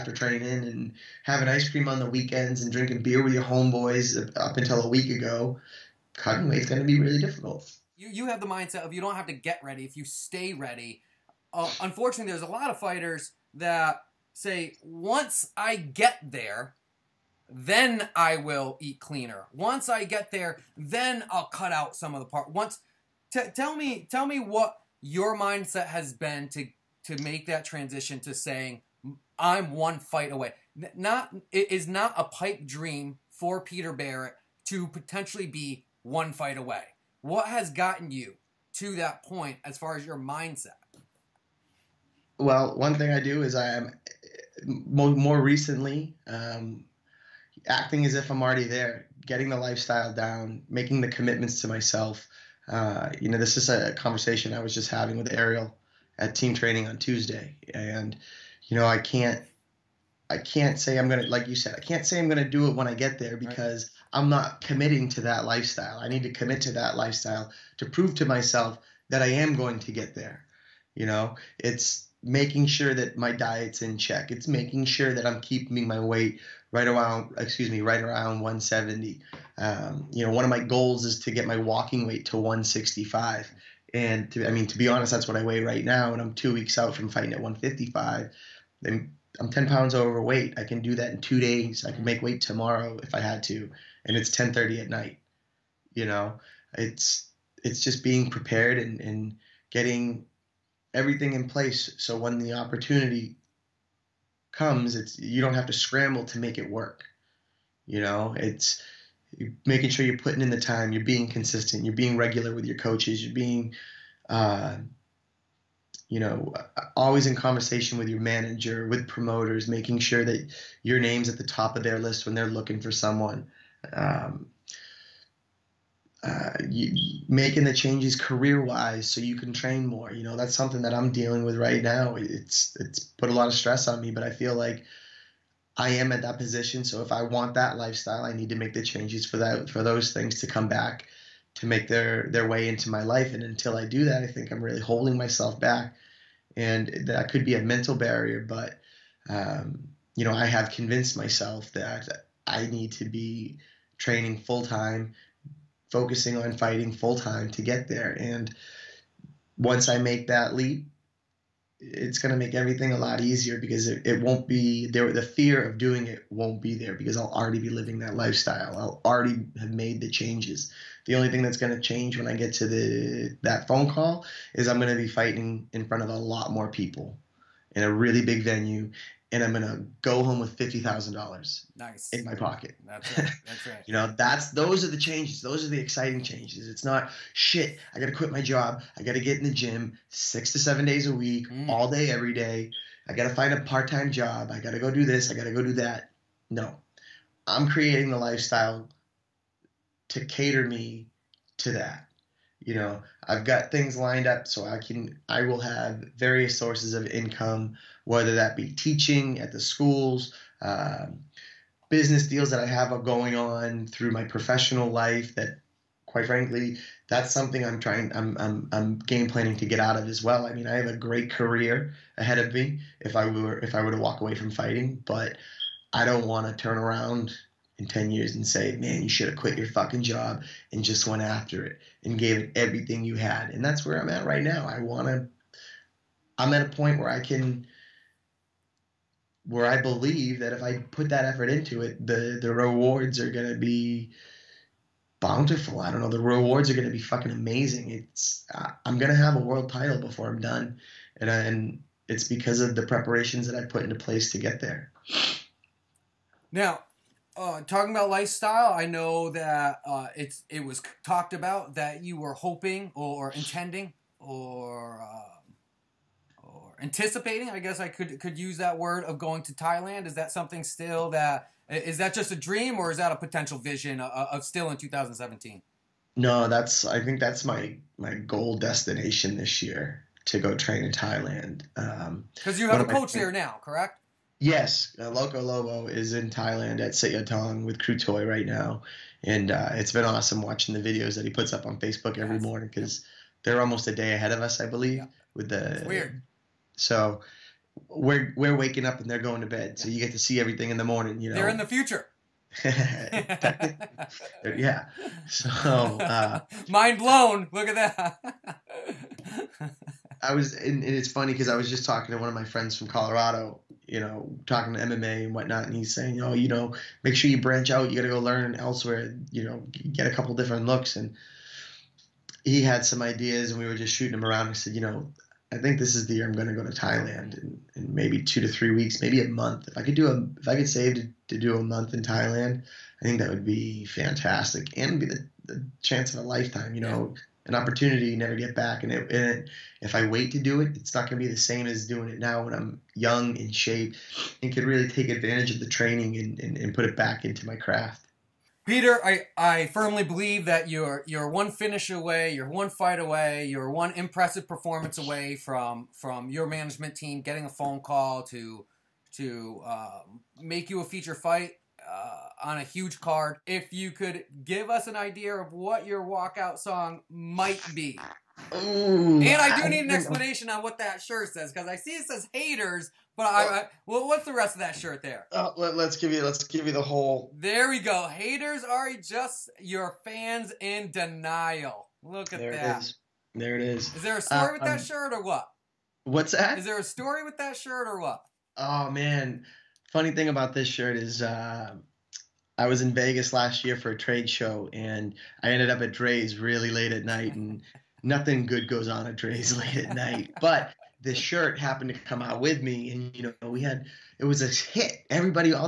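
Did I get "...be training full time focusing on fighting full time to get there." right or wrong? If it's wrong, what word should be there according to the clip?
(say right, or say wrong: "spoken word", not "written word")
right.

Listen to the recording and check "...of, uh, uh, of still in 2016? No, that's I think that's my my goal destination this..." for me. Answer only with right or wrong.
wrong.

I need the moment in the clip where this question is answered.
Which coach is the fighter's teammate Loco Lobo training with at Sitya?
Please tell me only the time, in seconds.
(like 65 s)
287 s.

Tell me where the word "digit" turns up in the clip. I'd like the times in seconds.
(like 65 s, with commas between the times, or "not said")
not said.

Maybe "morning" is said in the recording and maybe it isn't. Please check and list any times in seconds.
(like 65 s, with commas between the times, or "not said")
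292 s, 300 s.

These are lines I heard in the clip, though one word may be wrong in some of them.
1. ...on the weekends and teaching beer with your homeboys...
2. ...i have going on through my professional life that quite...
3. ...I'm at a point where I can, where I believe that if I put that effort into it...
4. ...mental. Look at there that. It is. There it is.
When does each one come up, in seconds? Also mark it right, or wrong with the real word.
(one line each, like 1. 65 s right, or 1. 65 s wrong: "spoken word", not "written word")
1. 1 s wrong: "drinking", not "teaching"
2. 212 s right
3. 236 s right
4. 380 s wrong: "denial", not "mental".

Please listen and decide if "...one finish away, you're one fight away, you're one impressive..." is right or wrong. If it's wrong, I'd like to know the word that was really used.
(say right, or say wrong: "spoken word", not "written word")
right.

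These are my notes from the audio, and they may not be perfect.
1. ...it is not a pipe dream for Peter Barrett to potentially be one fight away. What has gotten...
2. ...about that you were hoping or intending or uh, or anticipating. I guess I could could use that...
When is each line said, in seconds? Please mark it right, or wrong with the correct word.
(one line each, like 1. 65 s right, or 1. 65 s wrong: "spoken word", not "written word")
1. 31 s right
2. 261 s right.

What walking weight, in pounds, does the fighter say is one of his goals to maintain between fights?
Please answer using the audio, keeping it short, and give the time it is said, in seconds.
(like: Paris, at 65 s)
165, at 82 s.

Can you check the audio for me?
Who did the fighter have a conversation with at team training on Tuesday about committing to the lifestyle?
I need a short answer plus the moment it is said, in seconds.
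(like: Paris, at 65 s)
Ariel, at 55 s.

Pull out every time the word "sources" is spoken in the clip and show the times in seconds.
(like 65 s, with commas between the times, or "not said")
206 s.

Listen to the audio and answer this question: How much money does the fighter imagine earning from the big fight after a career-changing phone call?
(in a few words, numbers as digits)
$50,000.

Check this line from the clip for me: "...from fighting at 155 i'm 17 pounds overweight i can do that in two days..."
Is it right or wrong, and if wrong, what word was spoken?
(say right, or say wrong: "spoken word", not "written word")
wrong: "10", not "17".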